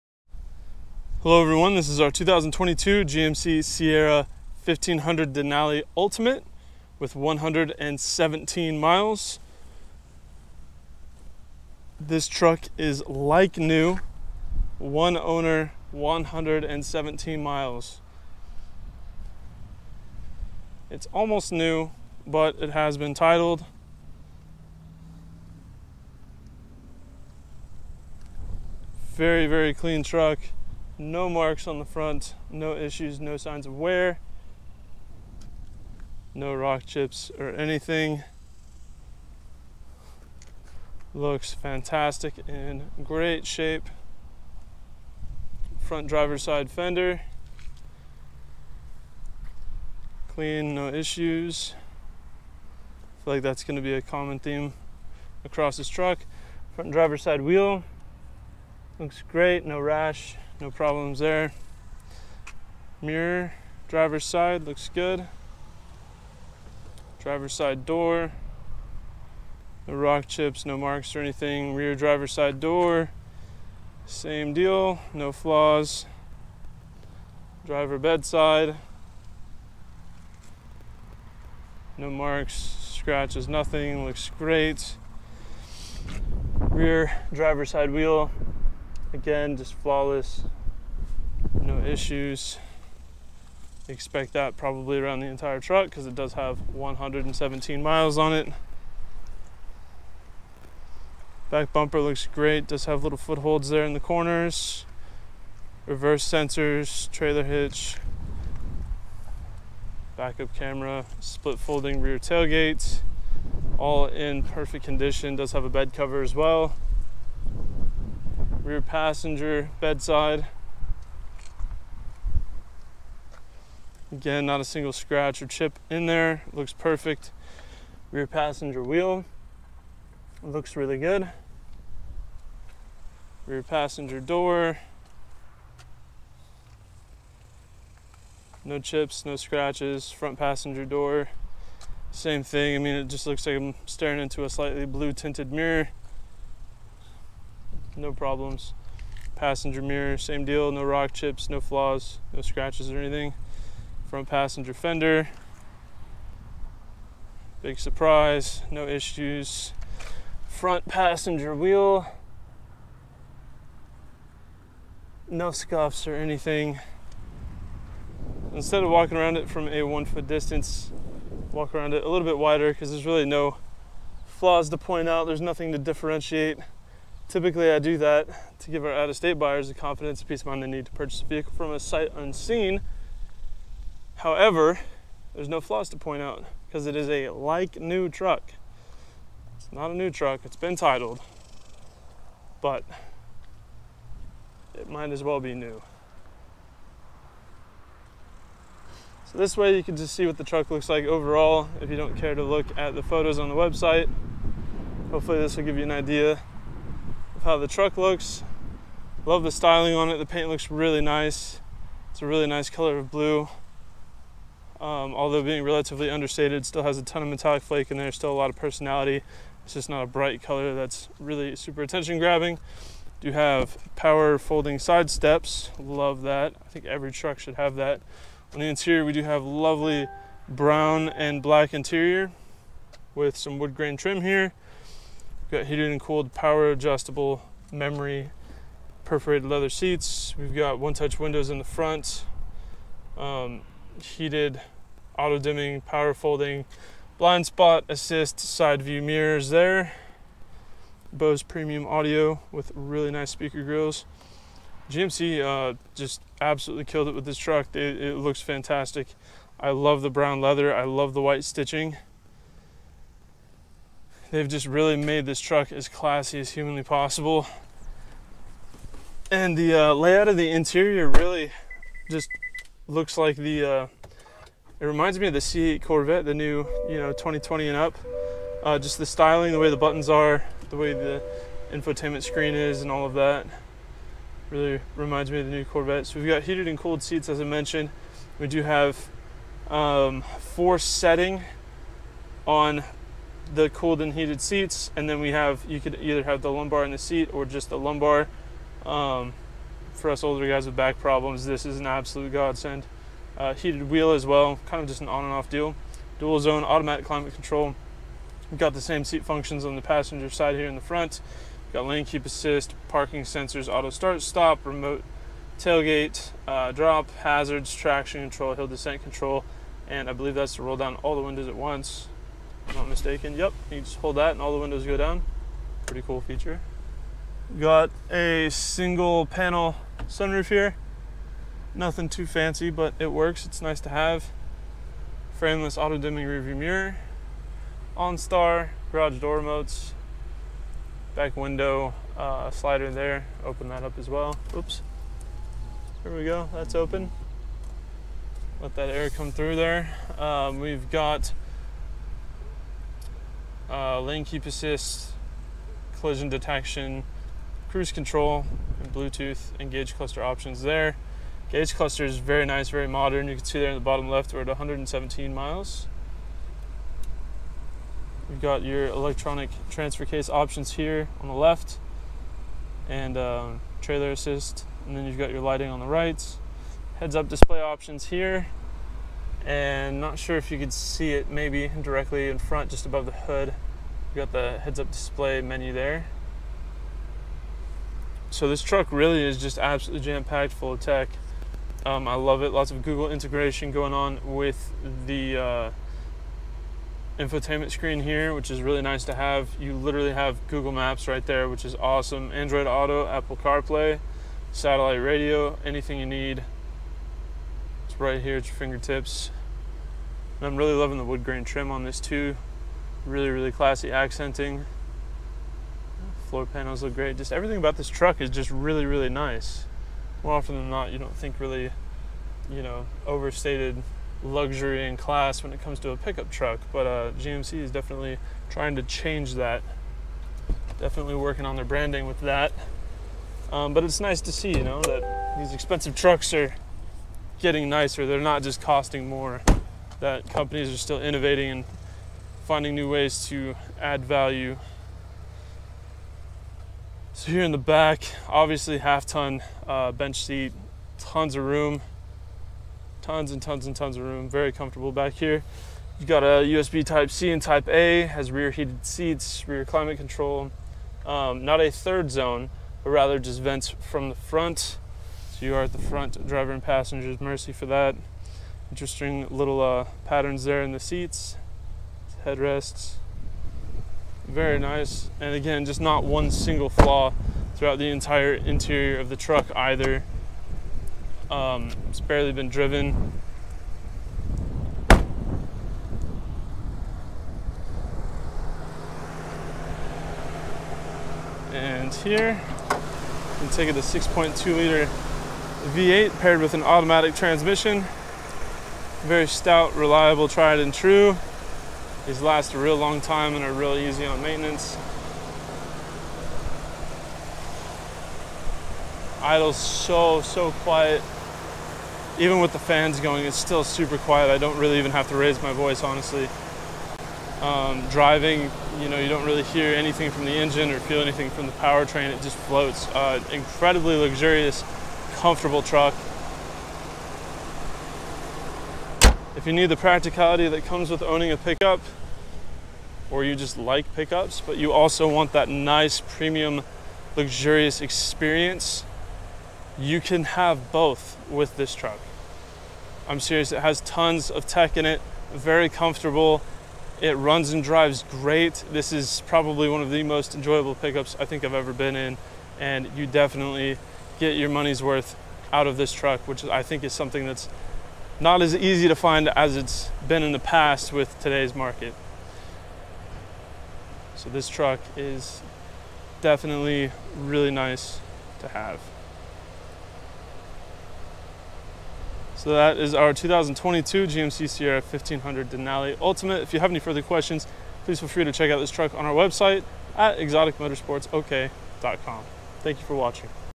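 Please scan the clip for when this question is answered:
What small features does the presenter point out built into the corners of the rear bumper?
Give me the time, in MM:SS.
01:43.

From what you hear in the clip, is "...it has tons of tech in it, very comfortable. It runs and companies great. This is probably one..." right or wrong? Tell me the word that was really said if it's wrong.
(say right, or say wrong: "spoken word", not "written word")
wrong: "drives", not "companies".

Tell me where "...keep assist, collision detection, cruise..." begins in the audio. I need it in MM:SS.
05:54.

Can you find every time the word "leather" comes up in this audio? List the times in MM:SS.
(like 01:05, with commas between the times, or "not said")
03:59, 04:20.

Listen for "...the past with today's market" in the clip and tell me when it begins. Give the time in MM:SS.
09:20.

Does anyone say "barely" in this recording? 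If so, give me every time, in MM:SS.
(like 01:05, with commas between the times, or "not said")
08:01.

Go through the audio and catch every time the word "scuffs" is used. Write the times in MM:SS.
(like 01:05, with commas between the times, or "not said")
02:45.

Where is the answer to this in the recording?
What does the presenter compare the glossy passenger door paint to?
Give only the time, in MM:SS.
02:24.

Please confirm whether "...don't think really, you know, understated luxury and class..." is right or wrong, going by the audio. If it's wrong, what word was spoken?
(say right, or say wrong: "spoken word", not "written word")
wrong: "overstated", not "understated".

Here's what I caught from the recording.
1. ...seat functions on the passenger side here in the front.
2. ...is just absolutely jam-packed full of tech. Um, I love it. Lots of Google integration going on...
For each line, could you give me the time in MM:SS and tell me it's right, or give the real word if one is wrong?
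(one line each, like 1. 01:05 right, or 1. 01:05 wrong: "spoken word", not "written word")
1. 05:09 right
2. 06:29 right.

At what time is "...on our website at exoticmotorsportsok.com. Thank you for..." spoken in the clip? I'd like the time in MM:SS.
09:38.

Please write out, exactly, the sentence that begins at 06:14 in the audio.
And then you've got your lighting on the right.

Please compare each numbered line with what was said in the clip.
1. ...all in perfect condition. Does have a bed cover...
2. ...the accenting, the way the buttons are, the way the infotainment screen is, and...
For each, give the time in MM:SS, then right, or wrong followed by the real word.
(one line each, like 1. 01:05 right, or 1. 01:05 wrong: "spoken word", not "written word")
1. 01:53 right
2. 04:38 wrong: "styling", not "accenting".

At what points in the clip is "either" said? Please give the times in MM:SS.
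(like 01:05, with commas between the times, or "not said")
04:56, 07:59.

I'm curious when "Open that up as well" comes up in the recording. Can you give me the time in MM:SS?
05:43.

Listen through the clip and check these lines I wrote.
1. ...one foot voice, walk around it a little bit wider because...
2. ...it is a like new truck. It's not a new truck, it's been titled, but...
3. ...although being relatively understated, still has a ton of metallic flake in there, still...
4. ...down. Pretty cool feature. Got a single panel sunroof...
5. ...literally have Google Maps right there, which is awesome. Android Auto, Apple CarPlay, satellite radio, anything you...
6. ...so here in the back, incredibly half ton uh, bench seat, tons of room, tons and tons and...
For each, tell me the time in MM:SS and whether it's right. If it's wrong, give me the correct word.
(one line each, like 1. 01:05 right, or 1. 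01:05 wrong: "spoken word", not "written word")
1. 02:49 wrong: "distance", not "voice"
2. 03:06 right
3. 03:35 right
4. 05:24 right
5. 06:39 right
6. 07:27 wrong: "obviously", not "incredibly".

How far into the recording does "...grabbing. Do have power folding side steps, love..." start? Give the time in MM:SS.
03:42.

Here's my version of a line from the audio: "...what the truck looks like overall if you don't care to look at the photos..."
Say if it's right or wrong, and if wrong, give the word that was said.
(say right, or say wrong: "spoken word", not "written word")
right.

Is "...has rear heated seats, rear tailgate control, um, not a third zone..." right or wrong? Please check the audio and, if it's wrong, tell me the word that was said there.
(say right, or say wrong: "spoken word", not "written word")
wrong: "climate", not "tailgate".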